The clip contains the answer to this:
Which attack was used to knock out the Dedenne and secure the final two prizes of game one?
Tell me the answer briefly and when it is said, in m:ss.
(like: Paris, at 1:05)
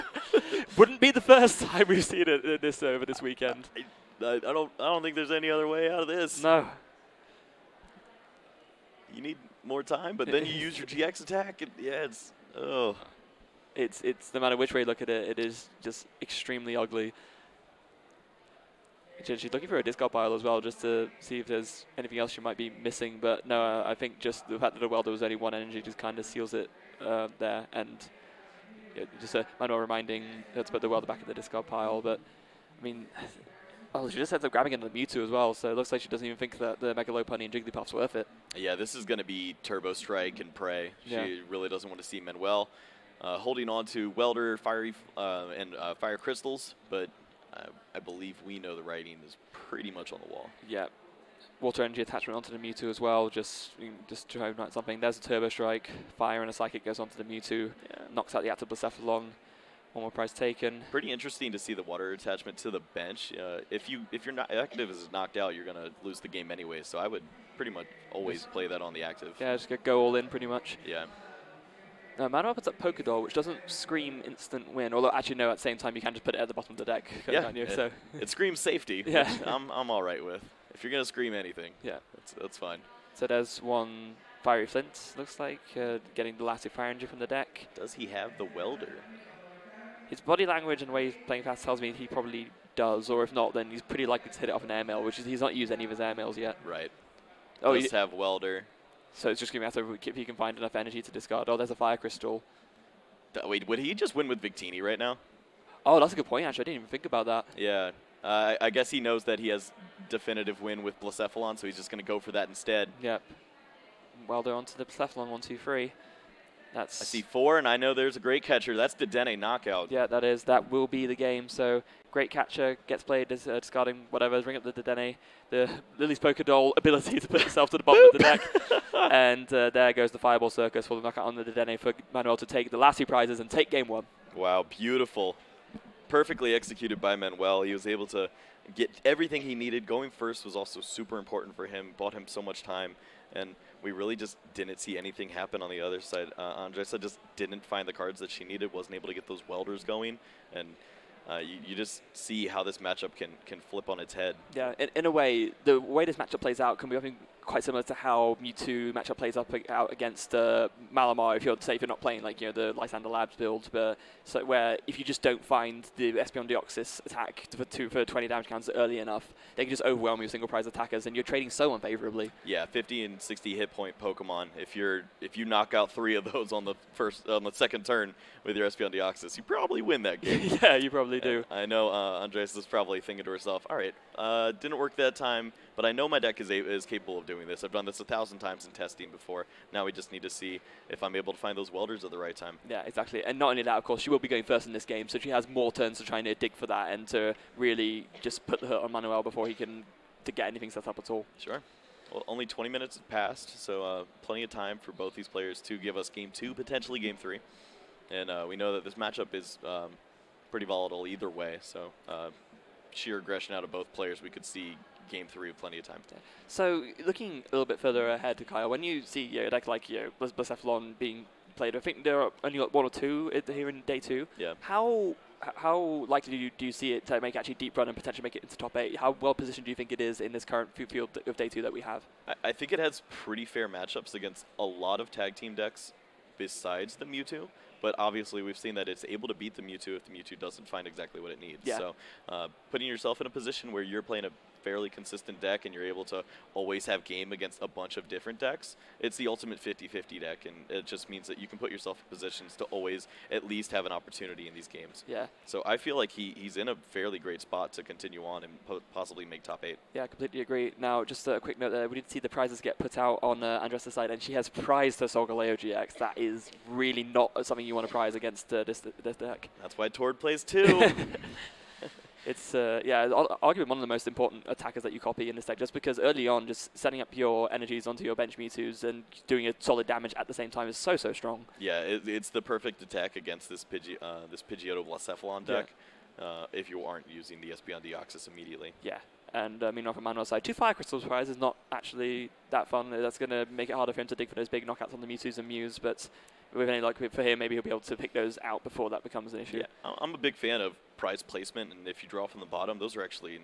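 Fireball Circus, at 2:10.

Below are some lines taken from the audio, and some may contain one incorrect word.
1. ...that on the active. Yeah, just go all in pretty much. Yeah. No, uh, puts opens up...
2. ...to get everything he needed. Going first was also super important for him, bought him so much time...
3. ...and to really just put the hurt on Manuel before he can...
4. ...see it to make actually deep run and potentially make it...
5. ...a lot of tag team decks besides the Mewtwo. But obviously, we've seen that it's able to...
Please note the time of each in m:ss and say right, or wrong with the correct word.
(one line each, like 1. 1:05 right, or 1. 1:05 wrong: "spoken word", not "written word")
1. 1:08 right
2. 2:18 right
3. 3:16 right
4. 3:46 right
5. 3:54 right.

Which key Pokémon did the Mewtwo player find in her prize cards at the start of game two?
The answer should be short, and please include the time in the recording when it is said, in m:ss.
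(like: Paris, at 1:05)
Solgaleo GX, at 4:25.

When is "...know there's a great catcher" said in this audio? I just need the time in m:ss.
1:57.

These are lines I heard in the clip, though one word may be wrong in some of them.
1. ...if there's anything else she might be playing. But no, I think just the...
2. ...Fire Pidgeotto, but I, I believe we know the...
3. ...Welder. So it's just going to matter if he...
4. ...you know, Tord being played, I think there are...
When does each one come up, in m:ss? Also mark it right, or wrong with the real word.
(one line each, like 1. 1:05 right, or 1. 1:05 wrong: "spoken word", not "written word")
1. 0:21 wrong: "missing", not "playing"
2. 0:45 wrong: "Crystals", not "Pidgeotto"
3. 1:38 right
4. 3:39 wrong: "Blacephalon", not "Tord".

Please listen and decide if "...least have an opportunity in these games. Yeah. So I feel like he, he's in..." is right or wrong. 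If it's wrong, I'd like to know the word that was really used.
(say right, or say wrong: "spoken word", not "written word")
right.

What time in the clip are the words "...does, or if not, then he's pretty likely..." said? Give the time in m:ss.
1:32.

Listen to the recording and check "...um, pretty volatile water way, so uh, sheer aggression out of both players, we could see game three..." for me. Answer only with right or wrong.
wrong.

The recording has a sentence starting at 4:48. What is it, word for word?
Yeah, and uh, I mean, from Manuel's side, two Fire Crystal Surprise is not actually that fun.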